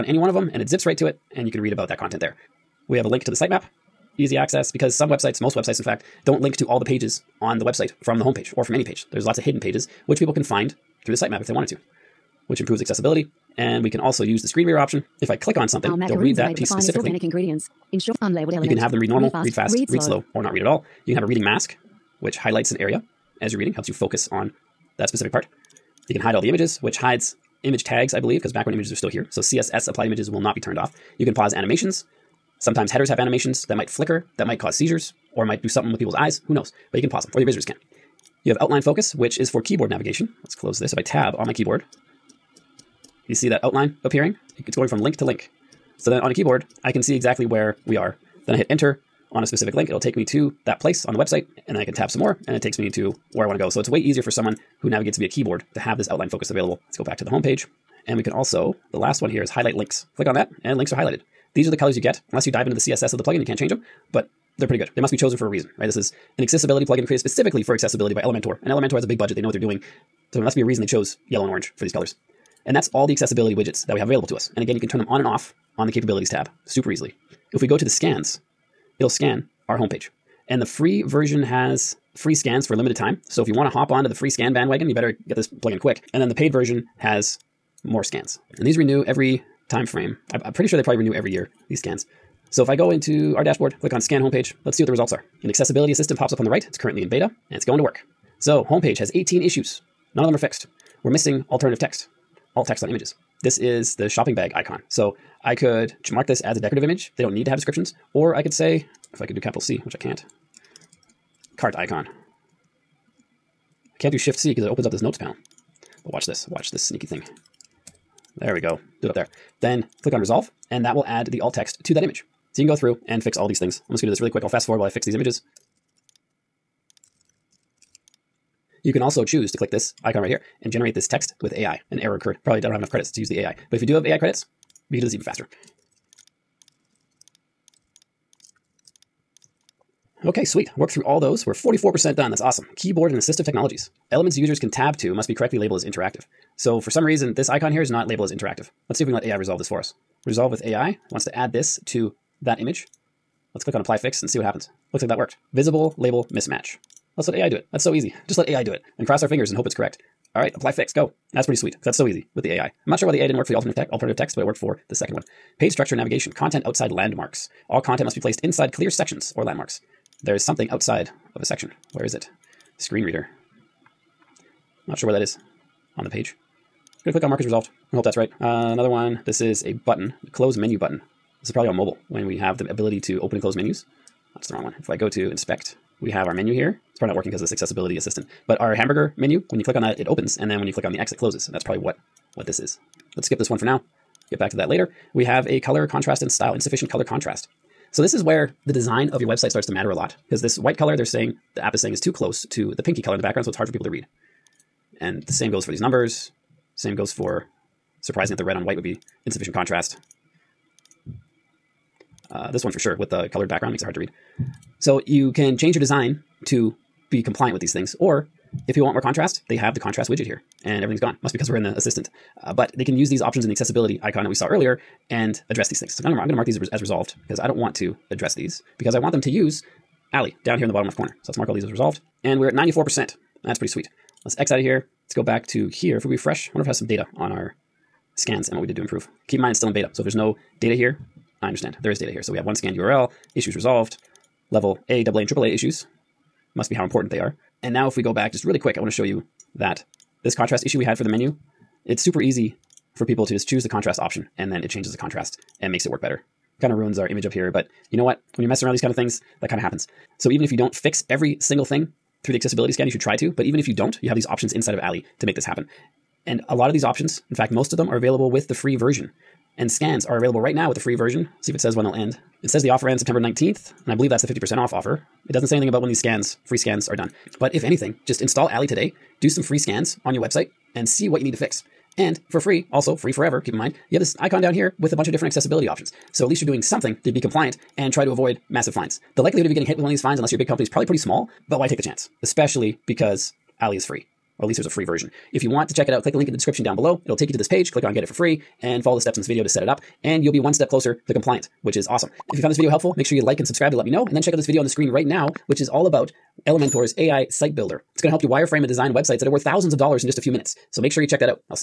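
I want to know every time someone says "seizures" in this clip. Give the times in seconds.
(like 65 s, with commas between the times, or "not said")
34 s.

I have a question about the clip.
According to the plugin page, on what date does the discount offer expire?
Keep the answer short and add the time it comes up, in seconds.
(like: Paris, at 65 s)
September 19th, at 272 s.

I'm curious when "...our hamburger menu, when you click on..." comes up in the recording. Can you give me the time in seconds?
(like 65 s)
188 s.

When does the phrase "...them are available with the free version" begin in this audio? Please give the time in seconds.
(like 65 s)
267 s.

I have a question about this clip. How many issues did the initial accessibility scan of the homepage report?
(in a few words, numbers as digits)
18.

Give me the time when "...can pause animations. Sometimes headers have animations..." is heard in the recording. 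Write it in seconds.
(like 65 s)
31 s.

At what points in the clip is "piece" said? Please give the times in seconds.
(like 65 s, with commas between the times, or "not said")
16 s.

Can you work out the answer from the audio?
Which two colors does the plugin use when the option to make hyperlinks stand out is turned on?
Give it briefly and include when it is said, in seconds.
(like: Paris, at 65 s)
yellow and orange, at 71 s.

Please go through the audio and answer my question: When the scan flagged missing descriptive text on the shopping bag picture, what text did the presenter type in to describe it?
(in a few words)
cart icon.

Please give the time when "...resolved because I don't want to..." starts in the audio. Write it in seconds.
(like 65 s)
226 s.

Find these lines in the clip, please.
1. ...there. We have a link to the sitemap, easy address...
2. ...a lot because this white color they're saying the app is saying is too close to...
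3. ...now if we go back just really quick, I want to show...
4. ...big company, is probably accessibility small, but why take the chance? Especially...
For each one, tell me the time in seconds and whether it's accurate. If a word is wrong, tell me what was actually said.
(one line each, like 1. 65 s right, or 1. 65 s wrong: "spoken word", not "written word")
1. 2 s wrong: "access", not "address"
2. 199 s right
3. 247 s right
4. 290 s wrong: "pretty", not "accessibility".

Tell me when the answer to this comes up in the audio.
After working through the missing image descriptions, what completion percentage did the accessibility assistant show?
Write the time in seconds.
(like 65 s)
141 s.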